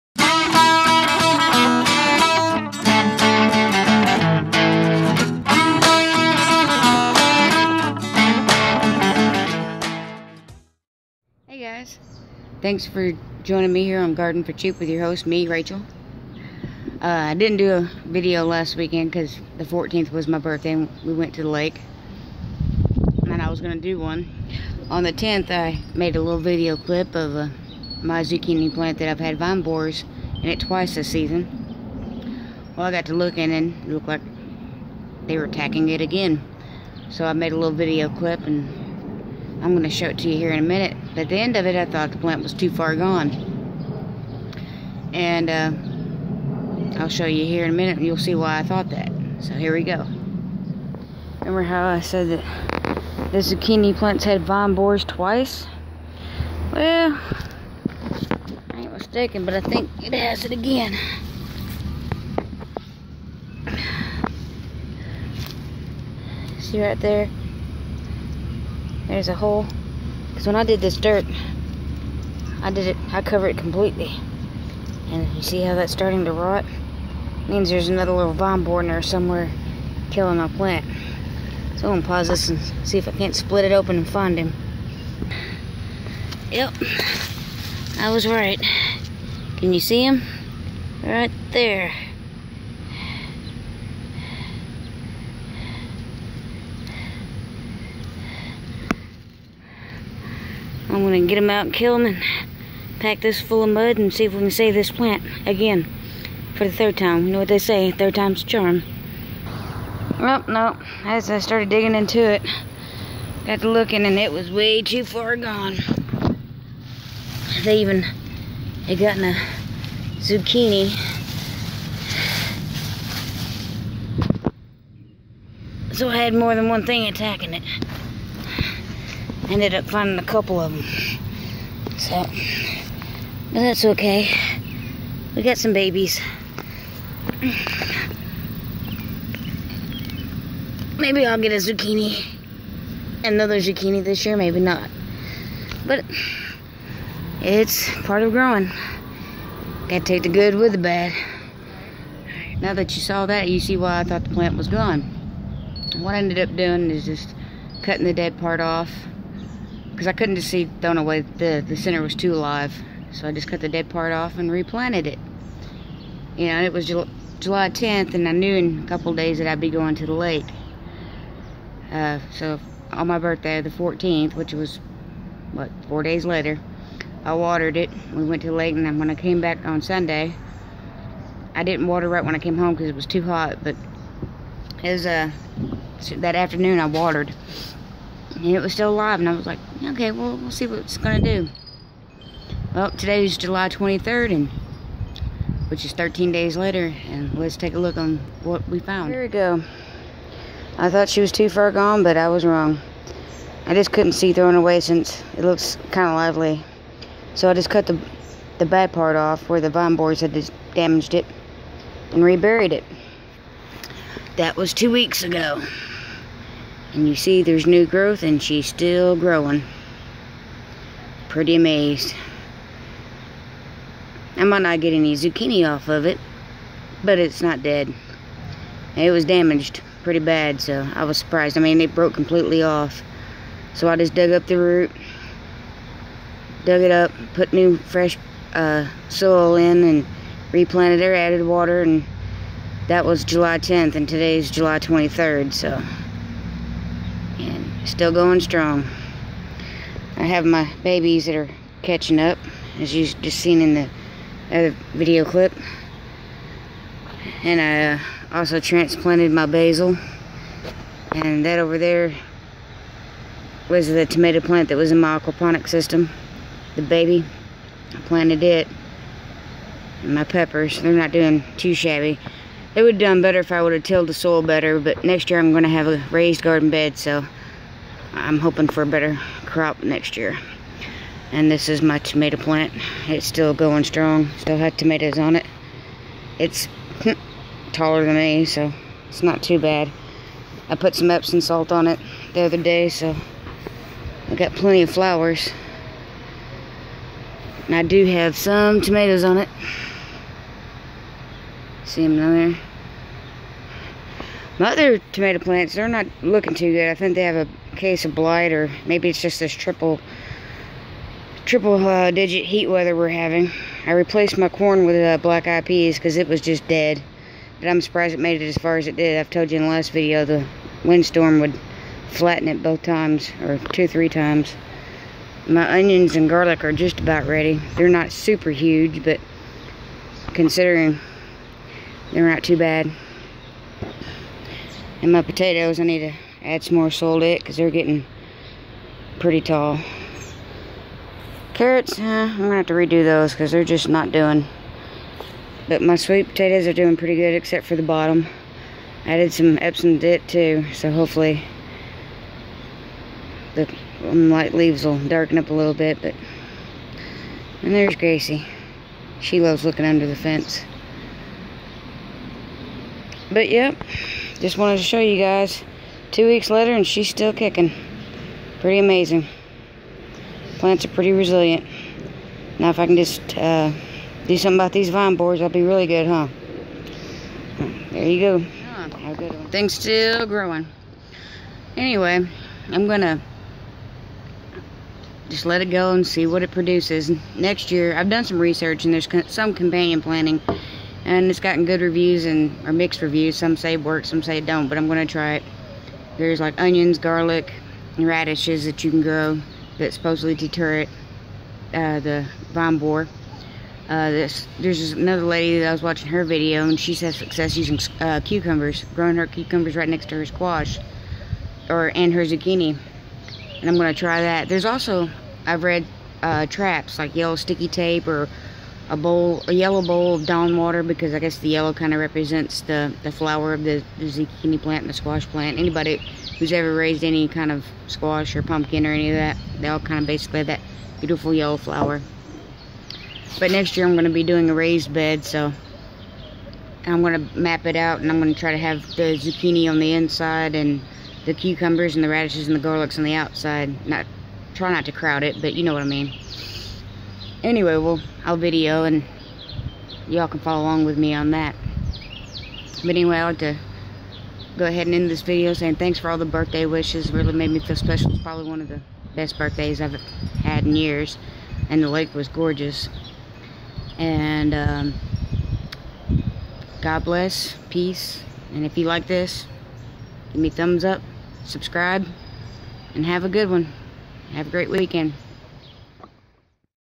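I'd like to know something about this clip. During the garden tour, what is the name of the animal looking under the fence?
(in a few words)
Gracie.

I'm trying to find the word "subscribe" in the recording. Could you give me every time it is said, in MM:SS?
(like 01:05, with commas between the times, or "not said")
07:51.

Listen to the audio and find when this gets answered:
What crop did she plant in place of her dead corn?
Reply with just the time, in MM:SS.
05:15.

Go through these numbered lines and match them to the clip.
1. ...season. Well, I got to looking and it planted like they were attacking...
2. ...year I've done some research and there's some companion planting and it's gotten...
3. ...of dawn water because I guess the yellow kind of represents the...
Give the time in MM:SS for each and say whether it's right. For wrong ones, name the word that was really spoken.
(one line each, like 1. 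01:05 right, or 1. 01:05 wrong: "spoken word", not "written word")
1. 00:31 wrong: "looked", not "planted"
2. 06:27 right
3. 07:00 right.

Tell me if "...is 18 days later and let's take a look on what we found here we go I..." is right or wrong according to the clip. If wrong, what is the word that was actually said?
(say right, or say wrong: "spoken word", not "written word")
wrong: "13", not "18".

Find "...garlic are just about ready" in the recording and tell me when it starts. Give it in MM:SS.
05:26.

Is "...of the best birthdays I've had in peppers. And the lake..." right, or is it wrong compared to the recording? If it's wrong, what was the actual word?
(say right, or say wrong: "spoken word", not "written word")
wrong: "years", not "peppers".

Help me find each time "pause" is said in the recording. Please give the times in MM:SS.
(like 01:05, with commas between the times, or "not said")
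01:22.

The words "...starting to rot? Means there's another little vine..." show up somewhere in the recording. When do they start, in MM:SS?
01:15.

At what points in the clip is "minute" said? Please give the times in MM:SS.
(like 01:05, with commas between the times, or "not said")
00:40, 00:47.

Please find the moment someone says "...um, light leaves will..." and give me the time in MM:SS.
05:54.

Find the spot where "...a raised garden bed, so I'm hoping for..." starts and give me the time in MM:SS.
04:35.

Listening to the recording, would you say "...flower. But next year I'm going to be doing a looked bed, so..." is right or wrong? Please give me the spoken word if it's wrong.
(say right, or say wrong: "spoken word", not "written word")
wrong: "raised", not "looked".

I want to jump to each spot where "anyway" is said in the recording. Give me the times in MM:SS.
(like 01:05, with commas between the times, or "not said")
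06:21, 07:27, 07:32.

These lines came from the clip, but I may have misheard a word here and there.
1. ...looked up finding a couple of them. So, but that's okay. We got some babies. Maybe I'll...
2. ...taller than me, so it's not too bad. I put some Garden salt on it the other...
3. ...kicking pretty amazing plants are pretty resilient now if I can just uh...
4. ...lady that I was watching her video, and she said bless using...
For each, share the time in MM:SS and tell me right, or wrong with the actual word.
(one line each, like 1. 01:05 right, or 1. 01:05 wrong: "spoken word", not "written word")
1. 02:09 wrong: "ended", not "looked"
2. 04:47 wrong: "Epsom", not "Garden"
3. 06:07 right
4. 06:45 wrong: "success", not "bless".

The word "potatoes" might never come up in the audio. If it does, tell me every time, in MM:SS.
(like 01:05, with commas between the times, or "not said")
05:35, 05:46.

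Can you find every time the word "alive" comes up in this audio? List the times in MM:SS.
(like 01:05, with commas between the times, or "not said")
02:42, 03:08.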